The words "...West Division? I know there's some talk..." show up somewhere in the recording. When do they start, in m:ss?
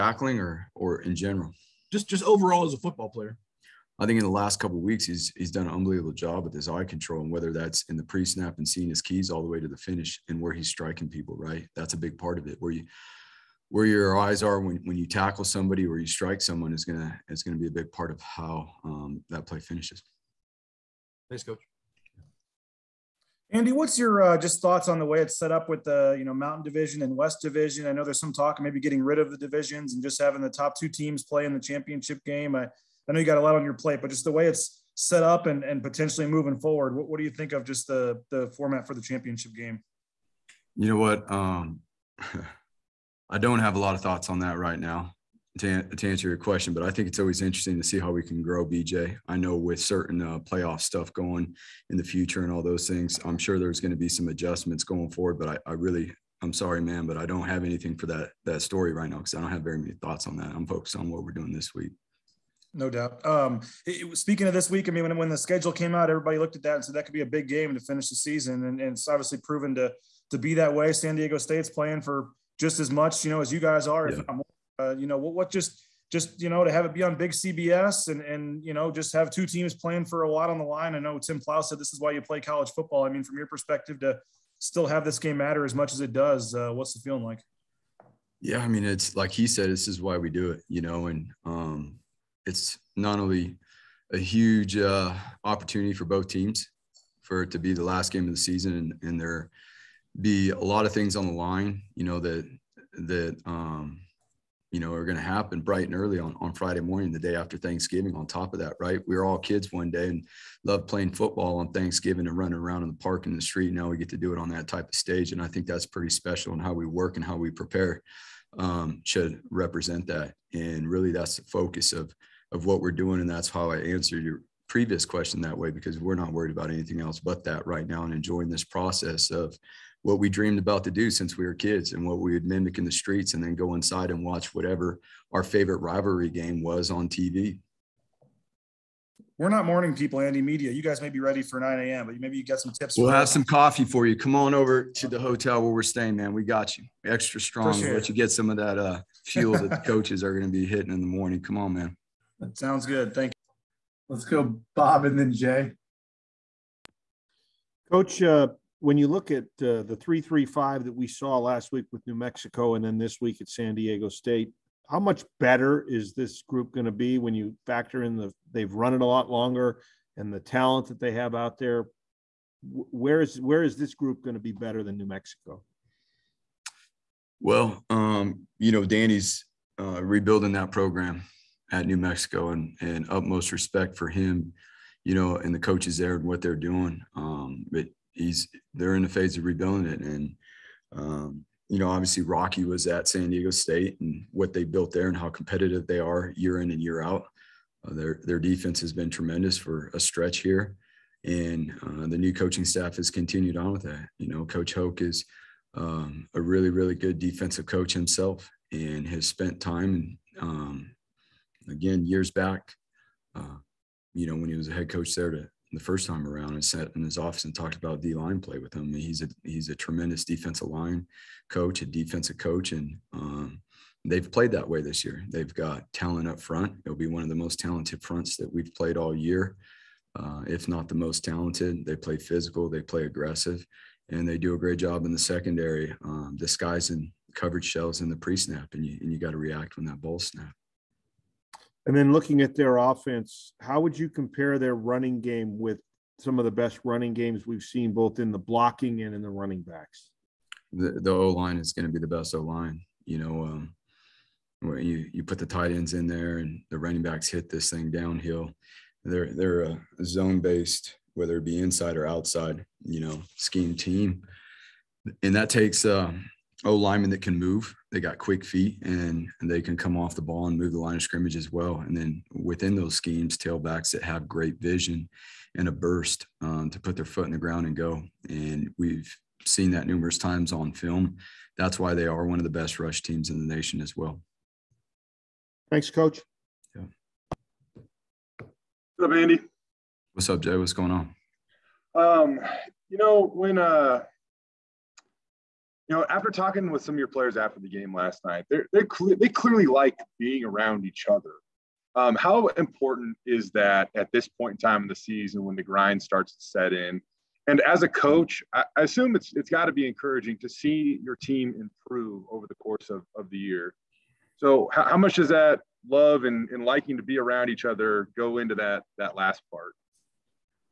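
0:27.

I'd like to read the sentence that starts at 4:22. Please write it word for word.
You know, scheme team, and that takes.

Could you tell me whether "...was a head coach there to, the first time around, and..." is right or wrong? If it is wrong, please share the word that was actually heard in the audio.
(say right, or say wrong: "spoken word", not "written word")
right.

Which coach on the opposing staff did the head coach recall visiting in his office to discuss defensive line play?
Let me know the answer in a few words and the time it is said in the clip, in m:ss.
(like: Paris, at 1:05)
Coach Hoke, at 3:24.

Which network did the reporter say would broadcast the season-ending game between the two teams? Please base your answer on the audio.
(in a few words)
CBS.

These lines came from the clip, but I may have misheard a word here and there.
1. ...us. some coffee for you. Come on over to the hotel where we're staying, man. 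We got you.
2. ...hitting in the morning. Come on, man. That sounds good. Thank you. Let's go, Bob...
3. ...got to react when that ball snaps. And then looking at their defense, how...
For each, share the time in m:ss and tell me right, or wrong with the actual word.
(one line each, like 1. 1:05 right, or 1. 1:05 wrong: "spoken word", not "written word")
1. 2:23 right
2. 2:30 right
3. 3:59 wrong: "offense", not "defense".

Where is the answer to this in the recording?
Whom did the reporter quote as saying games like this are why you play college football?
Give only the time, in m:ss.
1:21.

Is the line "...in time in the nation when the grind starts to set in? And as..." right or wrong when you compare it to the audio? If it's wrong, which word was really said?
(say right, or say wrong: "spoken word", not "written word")
wrong: "season", not "nation".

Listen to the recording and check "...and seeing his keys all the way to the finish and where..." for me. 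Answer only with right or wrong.
right.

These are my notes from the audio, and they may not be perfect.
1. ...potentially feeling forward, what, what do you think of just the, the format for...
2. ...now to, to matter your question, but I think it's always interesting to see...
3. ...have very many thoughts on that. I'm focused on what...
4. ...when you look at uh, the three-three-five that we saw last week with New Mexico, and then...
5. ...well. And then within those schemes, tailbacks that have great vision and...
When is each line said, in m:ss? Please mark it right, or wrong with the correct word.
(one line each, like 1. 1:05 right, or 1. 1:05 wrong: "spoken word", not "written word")
1. 0:35 wrong: "moving", not "feeling"
2. 0:44 wrong: "answer", not "matter"
3. 0:59 right
4. 2:38 right
5. 4:31 right.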